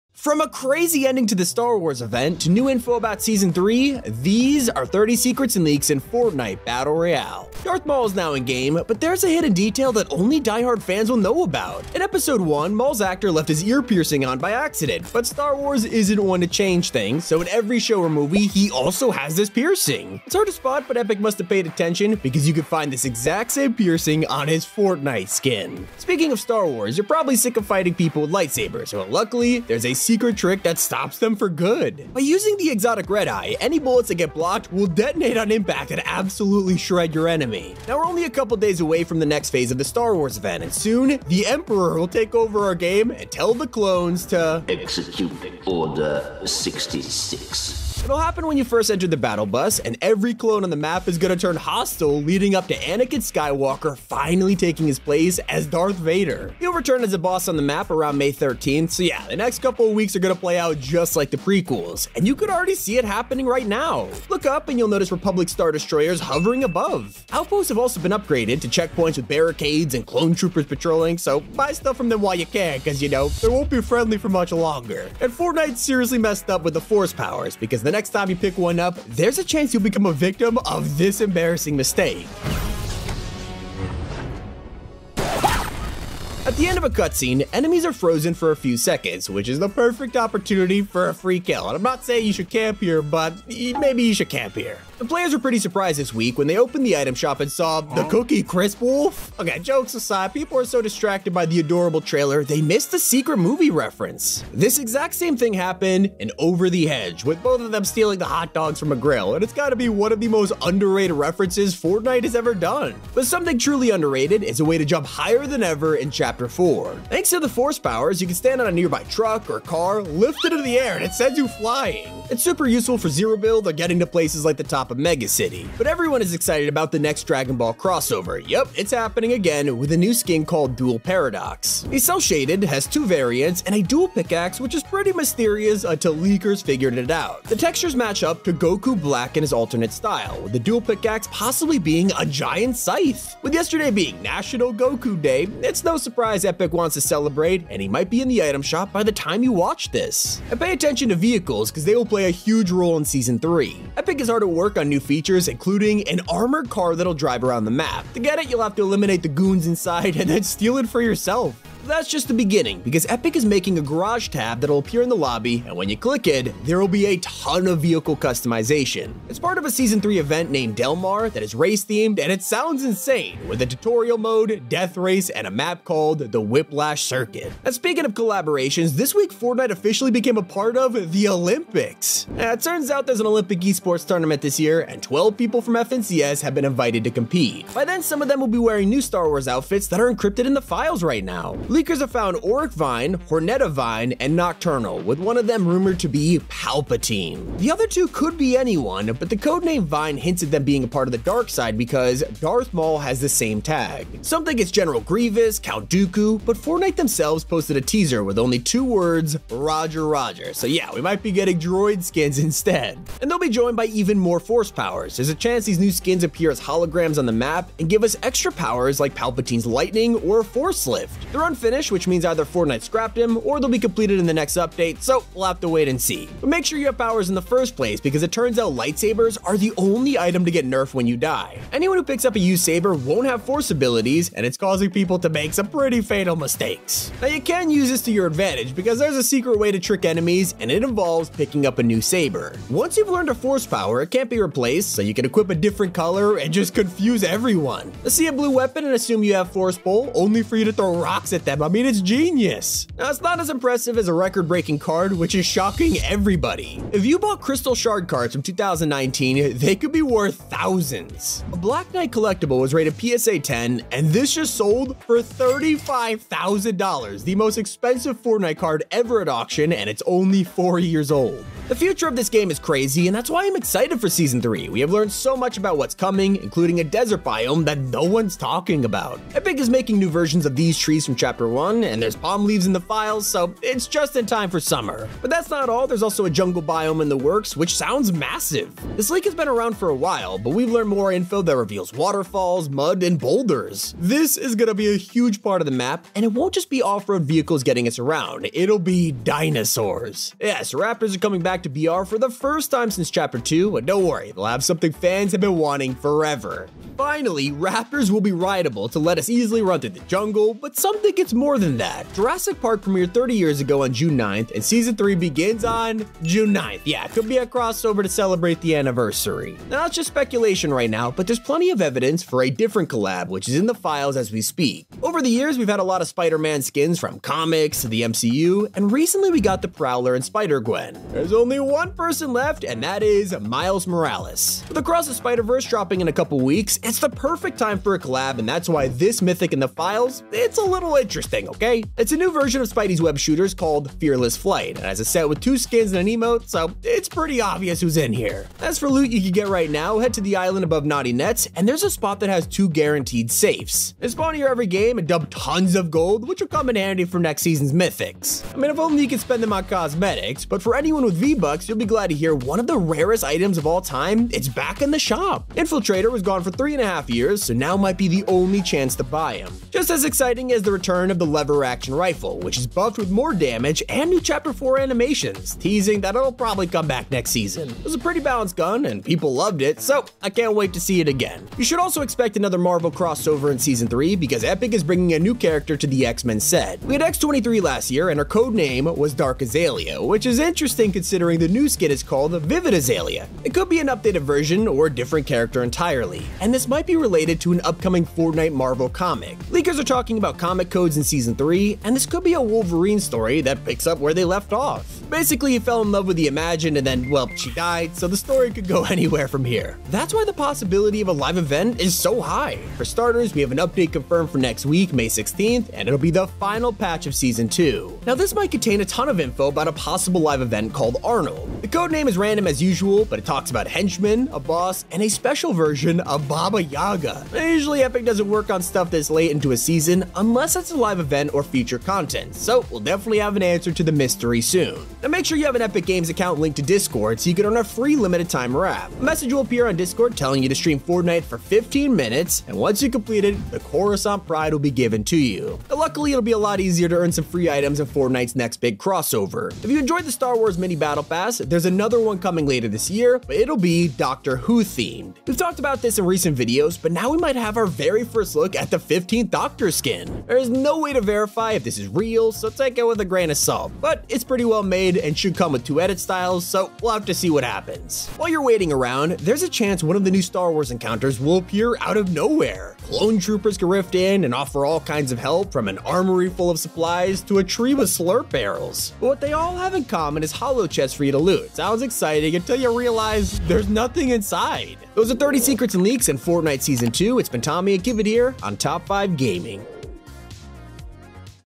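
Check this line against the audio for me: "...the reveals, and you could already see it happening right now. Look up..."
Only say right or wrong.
wrong.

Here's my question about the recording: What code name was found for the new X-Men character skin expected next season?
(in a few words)
Vivid Azalea.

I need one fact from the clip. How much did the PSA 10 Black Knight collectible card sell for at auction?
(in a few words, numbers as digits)
$35,000.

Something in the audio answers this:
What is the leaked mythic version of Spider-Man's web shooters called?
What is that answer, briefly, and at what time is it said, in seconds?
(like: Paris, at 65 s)
Fearless Flight, at 343 s.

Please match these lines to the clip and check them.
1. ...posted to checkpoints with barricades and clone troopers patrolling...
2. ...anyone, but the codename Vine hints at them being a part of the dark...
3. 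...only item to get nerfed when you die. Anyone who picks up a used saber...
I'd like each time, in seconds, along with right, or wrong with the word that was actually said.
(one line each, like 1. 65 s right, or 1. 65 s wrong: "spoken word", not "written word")
1. 68 s wrong: "upgraded", not "posted"
2. 198 s right
3. 229 s right.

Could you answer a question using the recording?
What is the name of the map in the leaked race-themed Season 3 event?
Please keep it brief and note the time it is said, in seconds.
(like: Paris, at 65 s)
Whiplash Circuit, at 176 s.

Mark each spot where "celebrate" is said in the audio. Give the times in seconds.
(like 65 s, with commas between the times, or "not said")
147 s, 318 s.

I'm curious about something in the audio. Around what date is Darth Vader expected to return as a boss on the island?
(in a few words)
May 13th.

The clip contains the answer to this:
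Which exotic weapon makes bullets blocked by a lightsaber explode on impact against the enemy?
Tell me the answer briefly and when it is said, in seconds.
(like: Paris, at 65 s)
Red Eye, at 32 s.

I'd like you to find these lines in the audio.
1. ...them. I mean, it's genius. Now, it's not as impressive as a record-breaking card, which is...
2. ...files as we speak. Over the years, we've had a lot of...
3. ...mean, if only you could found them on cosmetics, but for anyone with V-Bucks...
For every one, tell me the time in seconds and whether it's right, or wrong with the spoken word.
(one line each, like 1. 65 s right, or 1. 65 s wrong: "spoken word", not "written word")
1. 251 s right
2. 323 s right
3. 358 s wrong: "spend", not "found".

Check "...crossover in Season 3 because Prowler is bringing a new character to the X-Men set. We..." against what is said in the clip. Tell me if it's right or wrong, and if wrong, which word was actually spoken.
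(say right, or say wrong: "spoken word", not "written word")
wrong: "Epic", not "Prowler".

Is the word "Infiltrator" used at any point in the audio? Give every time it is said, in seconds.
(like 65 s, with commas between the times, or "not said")
365 s.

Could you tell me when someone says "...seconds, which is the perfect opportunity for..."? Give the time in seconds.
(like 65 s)
88 s.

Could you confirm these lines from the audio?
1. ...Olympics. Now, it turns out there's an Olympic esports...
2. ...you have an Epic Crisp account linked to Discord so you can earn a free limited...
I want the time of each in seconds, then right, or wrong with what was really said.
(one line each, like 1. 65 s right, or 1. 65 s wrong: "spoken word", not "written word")
1. 181 s right
2. 435 s wrong: "Games", not "Crisp".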